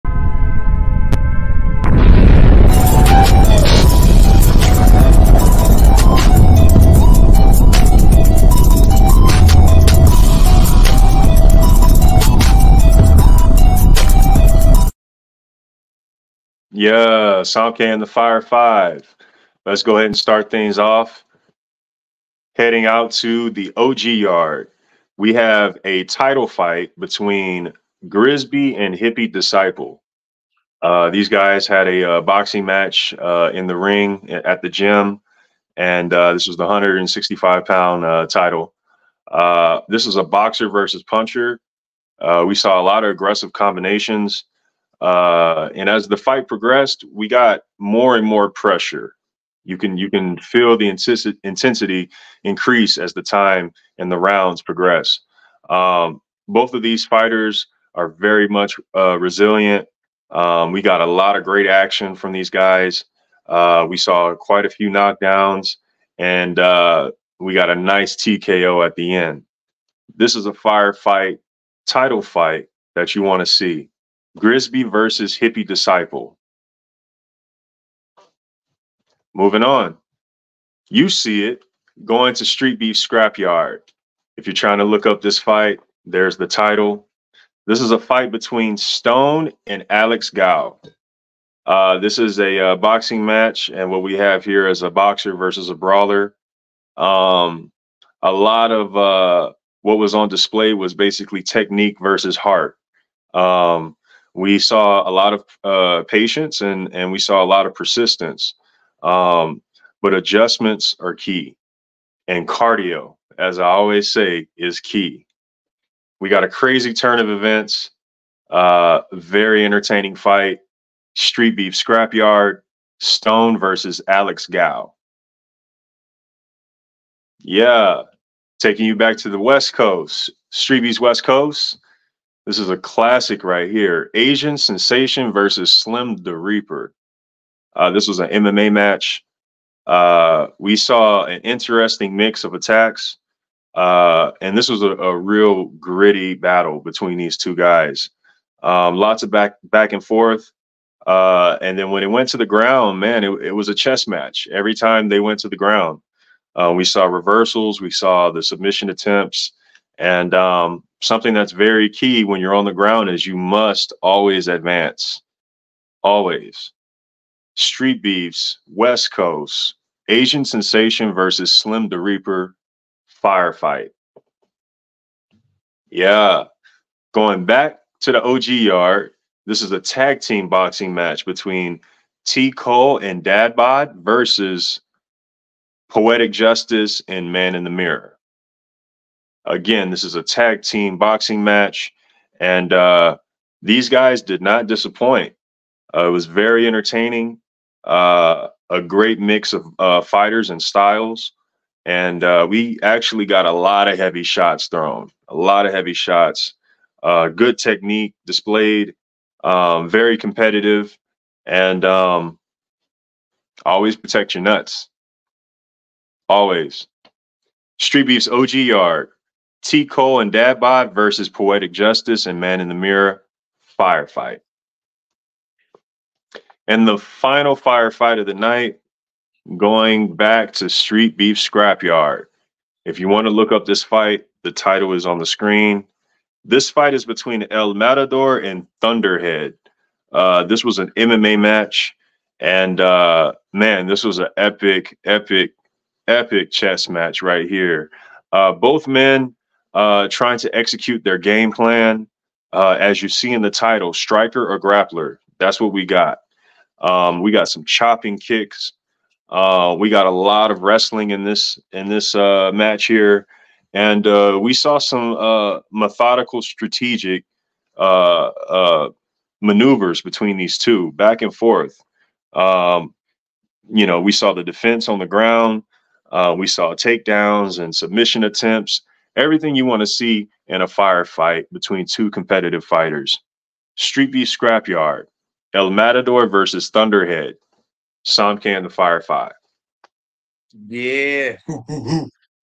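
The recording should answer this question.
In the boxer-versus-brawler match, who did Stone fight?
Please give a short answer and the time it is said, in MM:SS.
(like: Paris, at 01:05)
Alex Gao, at 01:29.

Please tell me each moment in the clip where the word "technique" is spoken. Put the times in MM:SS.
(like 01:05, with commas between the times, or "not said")
01:41, 03:27.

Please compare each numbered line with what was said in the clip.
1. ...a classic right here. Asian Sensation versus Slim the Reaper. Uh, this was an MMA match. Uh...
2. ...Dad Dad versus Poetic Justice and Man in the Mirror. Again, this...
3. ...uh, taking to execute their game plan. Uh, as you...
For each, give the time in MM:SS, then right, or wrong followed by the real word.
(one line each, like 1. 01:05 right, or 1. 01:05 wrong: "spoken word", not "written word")
1. 02:12 right
2. 03:03 wrong: "Bod", not "Dad"
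3. 04:09 wrong: "trying", not "taking".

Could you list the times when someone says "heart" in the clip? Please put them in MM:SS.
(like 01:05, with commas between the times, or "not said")
01:42.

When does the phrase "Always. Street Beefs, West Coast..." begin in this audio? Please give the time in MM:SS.
02:46.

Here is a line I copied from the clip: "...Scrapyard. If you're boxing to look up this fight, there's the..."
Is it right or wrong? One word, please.
wrong.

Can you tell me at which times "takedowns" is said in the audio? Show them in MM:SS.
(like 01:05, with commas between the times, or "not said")
04:36.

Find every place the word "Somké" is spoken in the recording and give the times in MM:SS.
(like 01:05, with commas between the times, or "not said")
00:17, 04:48.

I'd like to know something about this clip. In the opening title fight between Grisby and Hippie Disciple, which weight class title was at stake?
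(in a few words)
165 pound.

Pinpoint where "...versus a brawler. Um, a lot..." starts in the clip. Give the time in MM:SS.
01:35.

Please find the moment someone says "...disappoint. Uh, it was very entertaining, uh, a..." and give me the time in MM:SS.
03:14.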